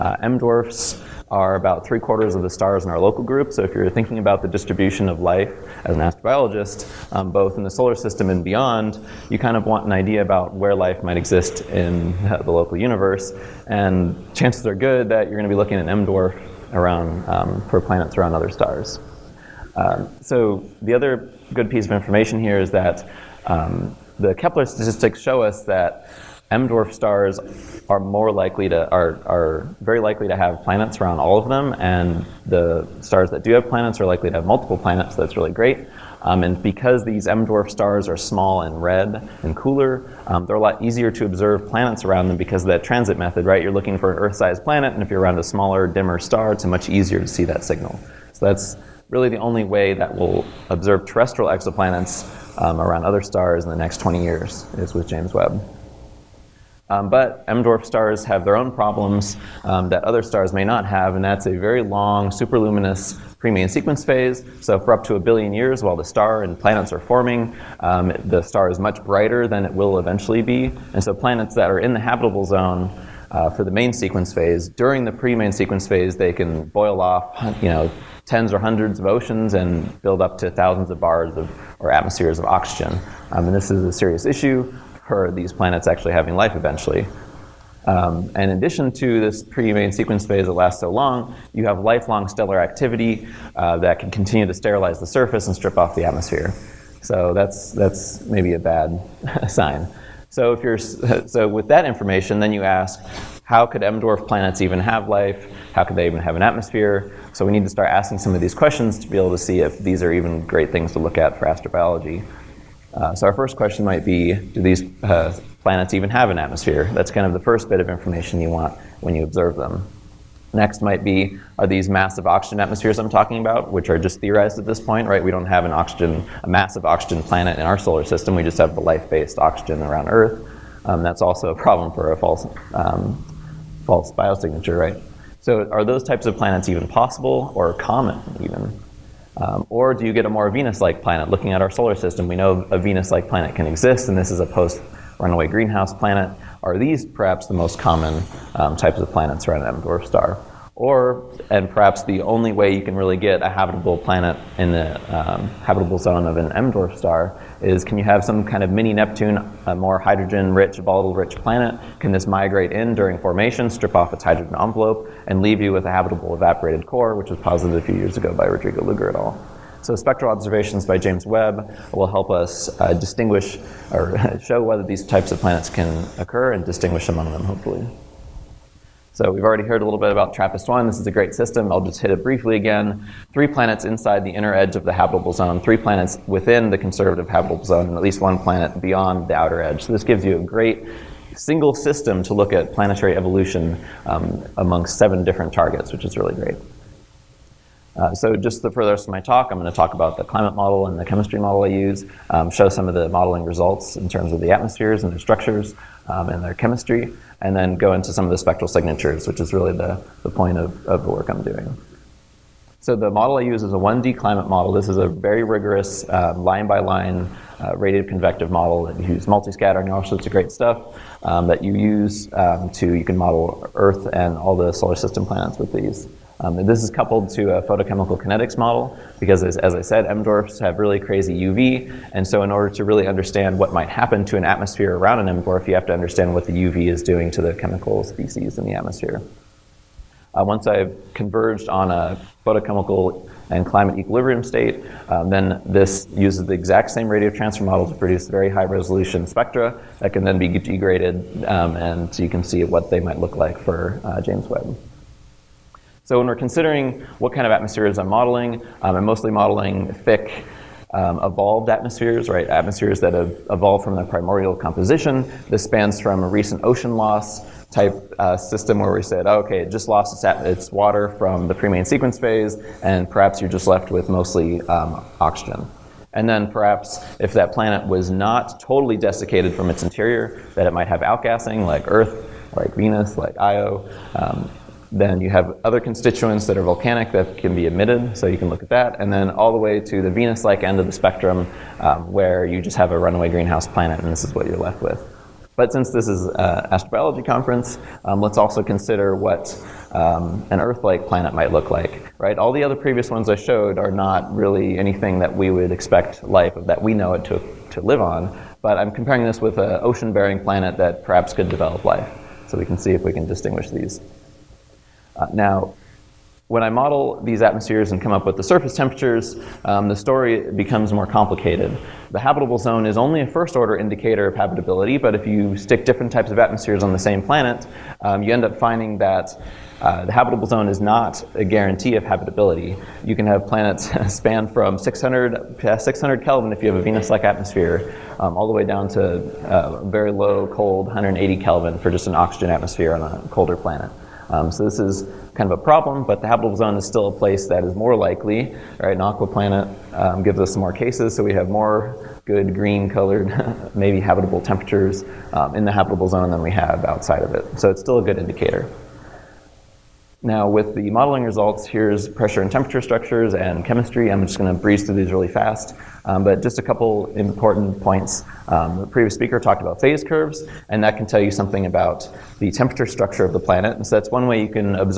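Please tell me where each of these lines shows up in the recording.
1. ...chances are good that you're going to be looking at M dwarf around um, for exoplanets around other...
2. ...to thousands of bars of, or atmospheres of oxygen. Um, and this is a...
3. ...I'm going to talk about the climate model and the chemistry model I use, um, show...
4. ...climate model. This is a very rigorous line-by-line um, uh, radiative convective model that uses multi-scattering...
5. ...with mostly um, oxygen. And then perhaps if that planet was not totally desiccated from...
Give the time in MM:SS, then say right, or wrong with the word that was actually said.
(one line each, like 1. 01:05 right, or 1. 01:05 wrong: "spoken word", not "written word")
1. 00:14 wrong: "planets", not "exoplanets"
2. 01:20 right
3. 03:19 right
4. 03:34 right
5. 04:33 right.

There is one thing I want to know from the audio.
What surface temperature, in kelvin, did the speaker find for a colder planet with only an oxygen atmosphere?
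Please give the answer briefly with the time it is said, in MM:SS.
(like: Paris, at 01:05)
180, at 05:40.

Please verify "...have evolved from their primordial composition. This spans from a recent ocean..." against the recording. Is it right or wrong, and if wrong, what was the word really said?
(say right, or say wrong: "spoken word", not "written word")
right.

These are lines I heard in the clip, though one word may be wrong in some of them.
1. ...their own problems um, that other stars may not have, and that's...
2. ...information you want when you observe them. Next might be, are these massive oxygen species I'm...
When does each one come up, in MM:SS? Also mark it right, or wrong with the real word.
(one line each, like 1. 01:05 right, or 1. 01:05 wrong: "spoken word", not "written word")
1. 00:58 right
2. 01:57 wrong: "atmospheres", not "species".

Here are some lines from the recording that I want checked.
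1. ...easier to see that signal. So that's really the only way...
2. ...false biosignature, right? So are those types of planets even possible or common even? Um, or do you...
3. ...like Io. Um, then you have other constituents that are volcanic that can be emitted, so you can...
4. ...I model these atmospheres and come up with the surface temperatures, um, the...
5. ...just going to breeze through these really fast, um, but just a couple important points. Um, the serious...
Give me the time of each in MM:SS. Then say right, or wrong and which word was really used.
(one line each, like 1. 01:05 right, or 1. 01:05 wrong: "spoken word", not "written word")
1. 00:46 right
2. 02:13 right
3. 04:43 right
4. 05:16 right
5. 06:04 wrong: "previous", not "serious".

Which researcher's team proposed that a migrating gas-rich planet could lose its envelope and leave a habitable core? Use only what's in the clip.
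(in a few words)
Rodrigo Luger.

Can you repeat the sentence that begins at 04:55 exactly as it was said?
But since this is an uh, astrobiology conference, um, let's also consider what um, an Earth-like planet might look like, right?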